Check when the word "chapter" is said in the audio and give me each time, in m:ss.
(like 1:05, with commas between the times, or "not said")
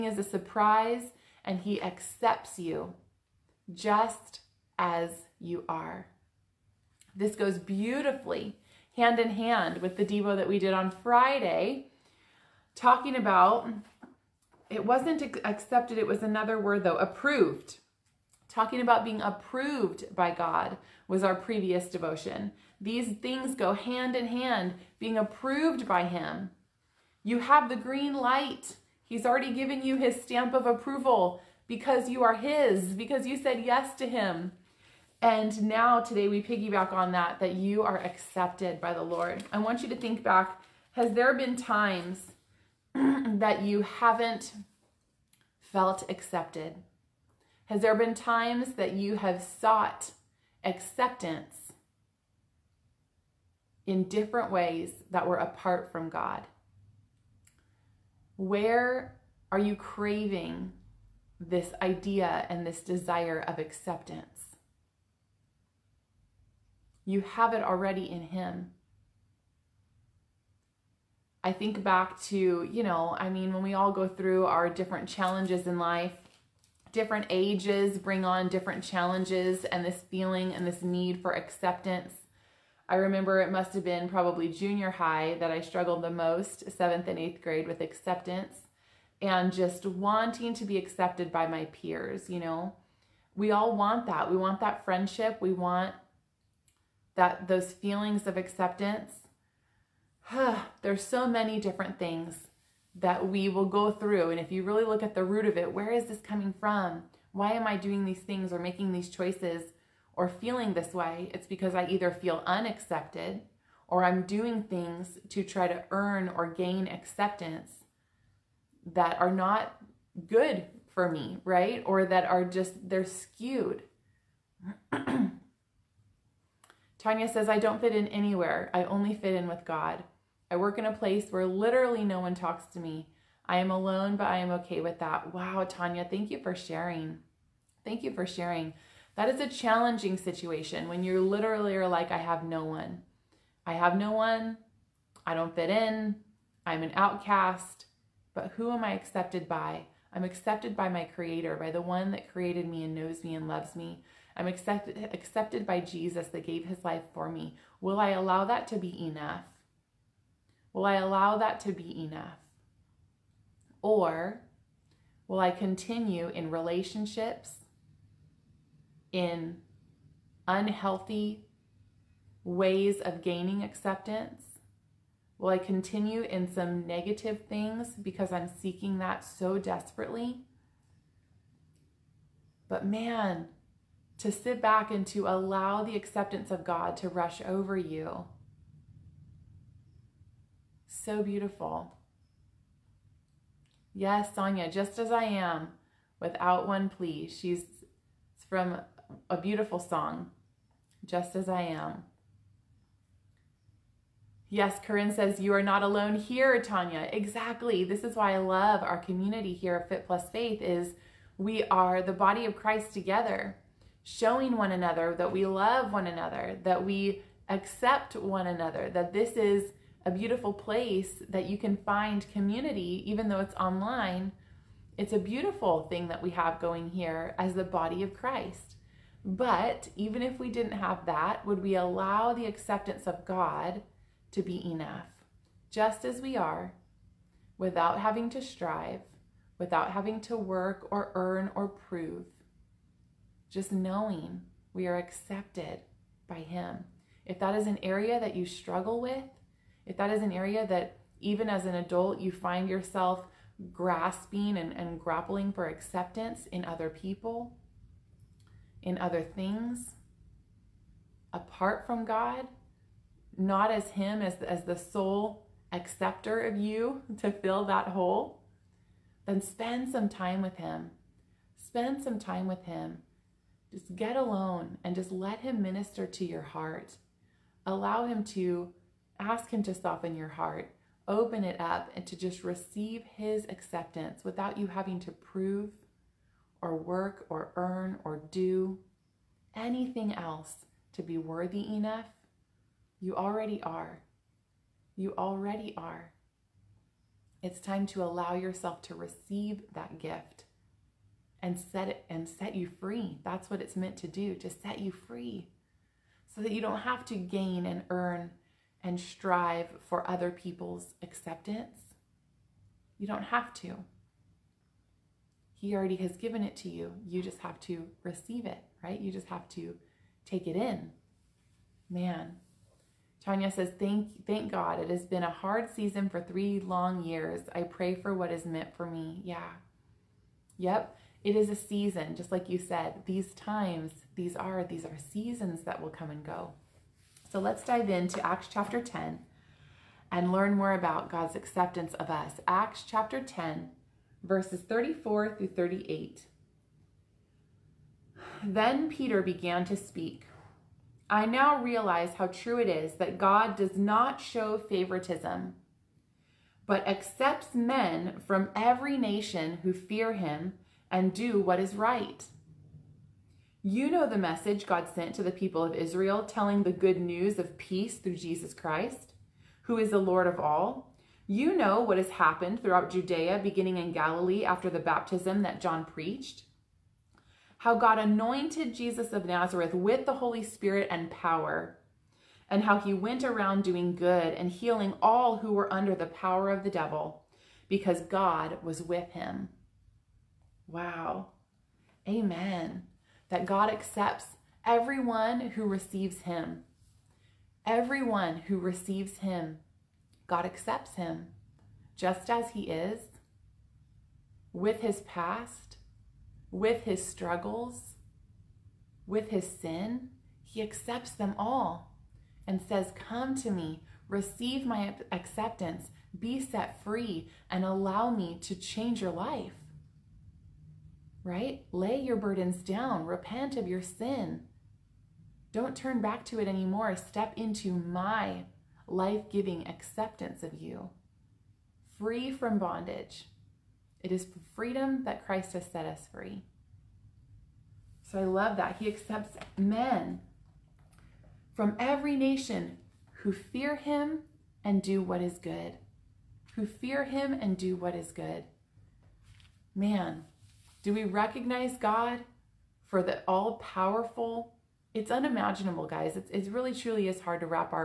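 5:38, 5:42.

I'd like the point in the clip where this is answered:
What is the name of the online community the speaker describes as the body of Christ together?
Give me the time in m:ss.
3:29.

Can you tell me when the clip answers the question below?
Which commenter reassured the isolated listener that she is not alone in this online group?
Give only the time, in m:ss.
3:24.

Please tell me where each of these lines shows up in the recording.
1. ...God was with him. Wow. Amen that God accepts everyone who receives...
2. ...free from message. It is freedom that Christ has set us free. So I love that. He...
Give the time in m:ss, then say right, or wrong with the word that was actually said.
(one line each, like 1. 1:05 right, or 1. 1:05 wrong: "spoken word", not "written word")
1. 6:28 right
2. 7:11 wrong: "bondage", not "message".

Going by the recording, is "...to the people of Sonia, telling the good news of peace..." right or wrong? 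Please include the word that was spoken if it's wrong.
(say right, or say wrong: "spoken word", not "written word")
wrong: "Israel", not "Sonia".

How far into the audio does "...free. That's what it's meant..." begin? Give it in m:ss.
5:02.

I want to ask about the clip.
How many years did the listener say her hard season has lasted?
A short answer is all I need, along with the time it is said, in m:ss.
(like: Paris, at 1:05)
3, at 5:26.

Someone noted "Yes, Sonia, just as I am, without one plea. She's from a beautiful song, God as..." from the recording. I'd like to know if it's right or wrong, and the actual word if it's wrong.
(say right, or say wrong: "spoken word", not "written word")
wrong: "Just", not "God".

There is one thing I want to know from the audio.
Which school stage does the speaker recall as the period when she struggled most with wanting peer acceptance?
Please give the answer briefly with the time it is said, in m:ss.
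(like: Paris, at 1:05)
Junior high, at 1:24.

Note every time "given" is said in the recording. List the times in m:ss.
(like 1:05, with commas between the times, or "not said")
0:29, 5:16.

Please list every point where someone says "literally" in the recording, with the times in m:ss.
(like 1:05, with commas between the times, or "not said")
2:11, 2:21.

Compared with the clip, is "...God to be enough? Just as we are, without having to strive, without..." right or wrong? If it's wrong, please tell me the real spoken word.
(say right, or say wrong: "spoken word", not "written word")
right.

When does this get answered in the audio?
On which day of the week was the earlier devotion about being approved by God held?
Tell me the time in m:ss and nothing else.
0:11.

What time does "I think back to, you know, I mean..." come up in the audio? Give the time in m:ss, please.
1:11.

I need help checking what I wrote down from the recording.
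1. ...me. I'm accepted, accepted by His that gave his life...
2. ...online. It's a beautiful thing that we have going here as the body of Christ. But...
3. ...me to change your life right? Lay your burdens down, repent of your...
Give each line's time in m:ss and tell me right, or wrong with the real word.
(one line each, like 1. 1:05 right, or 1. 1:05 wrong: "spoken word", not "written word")
1. 2:33 wrong: "Jesus", not "His"
2. 3:43 right
3. 6:58 right.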